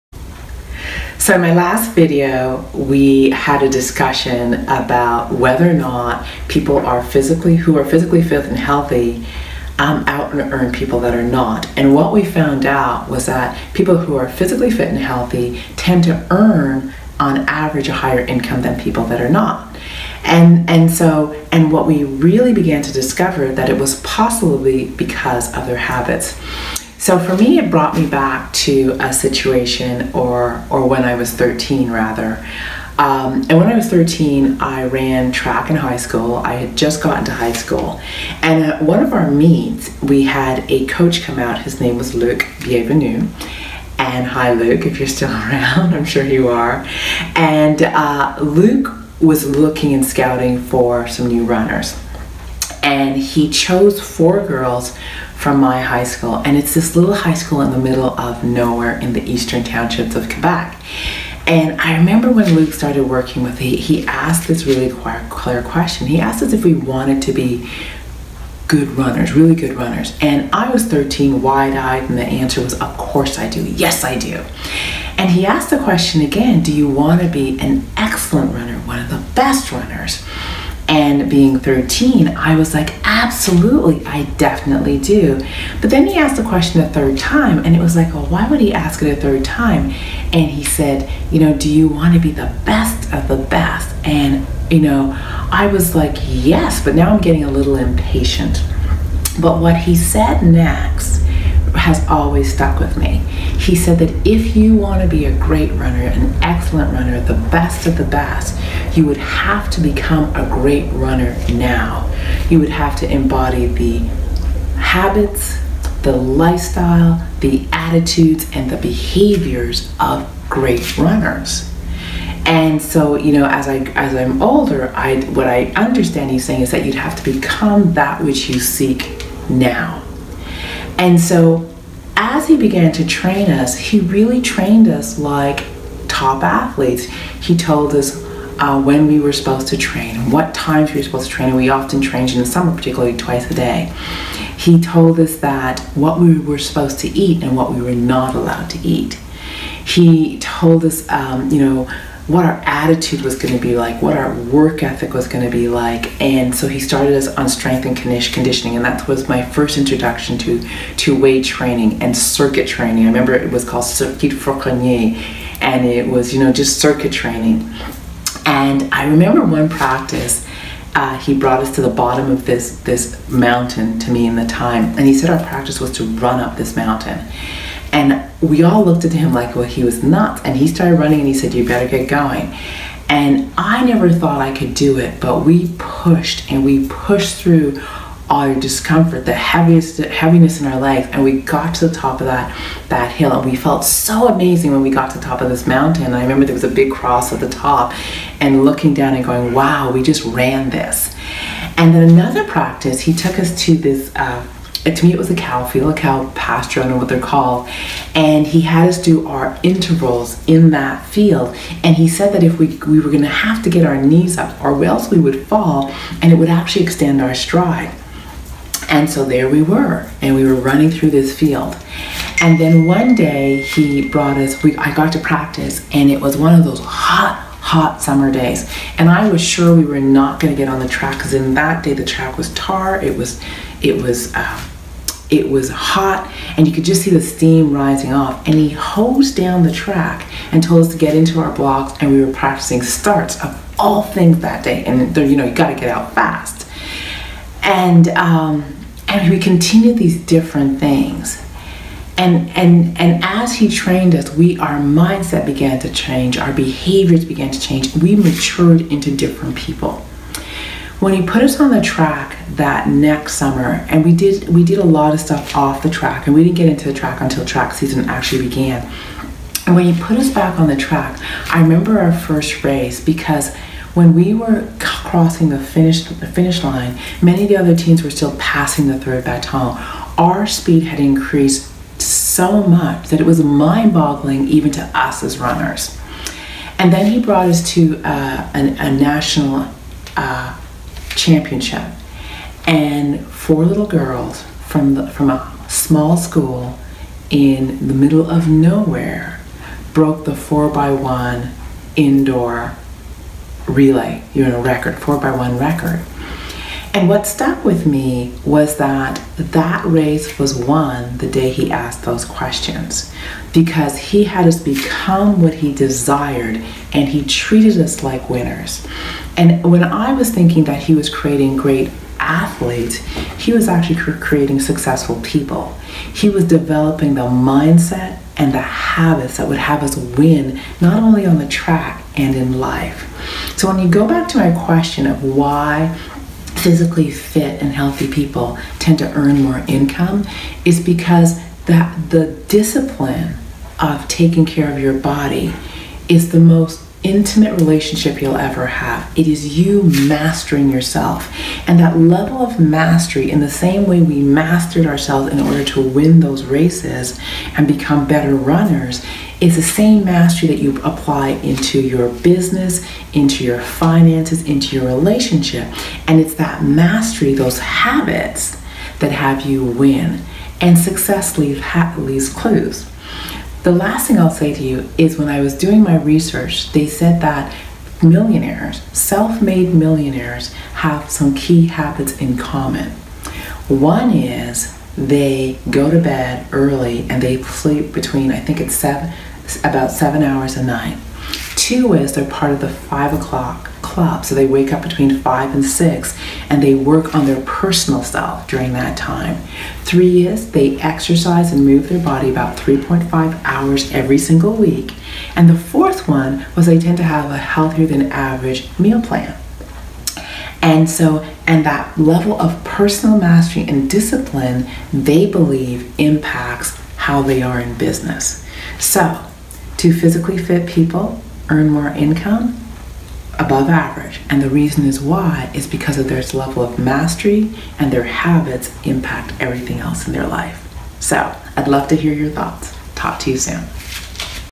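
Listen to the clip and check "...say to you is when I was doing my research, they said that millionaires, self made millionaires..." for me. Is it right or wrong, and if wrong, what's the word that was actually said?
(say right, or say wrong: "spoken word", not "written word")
right.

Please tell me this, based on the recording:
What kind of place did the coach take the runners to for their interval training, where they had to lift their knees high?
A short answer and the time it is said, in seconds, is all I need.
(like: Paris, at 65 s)
a cow pasture, at 205 s.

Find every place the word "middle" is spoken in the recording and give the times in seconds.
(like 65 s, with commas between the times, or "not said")
57 s, 297 s.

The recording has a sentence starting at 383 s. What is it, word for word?
One is they go to bed early and they sleep between, I think it's seven, about seven hours a night.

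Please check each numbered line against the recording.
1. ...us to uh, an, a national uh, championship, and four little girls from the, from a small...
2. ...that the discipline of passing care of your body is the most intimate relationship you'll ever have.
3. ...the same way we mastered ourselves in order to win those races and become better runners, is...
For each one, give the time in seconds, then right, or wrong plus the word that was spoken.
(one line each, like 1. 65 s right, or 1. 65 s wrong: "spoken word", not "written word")
1. 287 s right
2. 341 s wrong: "taking", not "passing"
3. 353 s right.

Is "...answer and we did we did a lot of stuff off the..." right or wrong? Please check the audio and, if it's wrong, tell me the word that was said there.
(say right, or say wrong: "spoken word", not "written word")
wrong: "summer", not "answer".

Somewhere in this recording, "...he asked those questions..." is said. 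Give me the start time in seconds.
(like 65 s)
311 s.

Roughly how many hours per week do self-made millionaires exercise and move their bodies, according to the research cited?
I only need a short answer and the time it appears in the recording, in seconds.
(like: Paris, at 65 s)
3.5 hours, at 402 s.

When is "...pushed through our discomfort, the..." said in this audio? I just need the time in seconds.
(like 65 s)
186 s.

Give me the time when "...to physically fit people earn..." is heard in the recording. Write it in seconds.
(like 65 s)
419 s.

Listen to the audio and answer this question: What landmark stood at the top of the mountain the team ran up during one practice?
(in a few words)
a big cross.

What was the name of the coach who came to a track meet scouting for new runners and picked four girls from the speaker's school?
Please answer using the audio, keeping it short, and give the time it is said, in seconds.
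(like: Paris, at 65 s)
Luke Bienvenu, at 42 s.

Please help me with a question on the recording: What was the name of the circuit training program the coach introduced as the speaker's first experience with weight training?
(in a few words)
Circuit Fauconnier.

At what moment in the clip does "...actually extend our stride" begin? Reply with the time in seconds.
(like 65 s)
216 s.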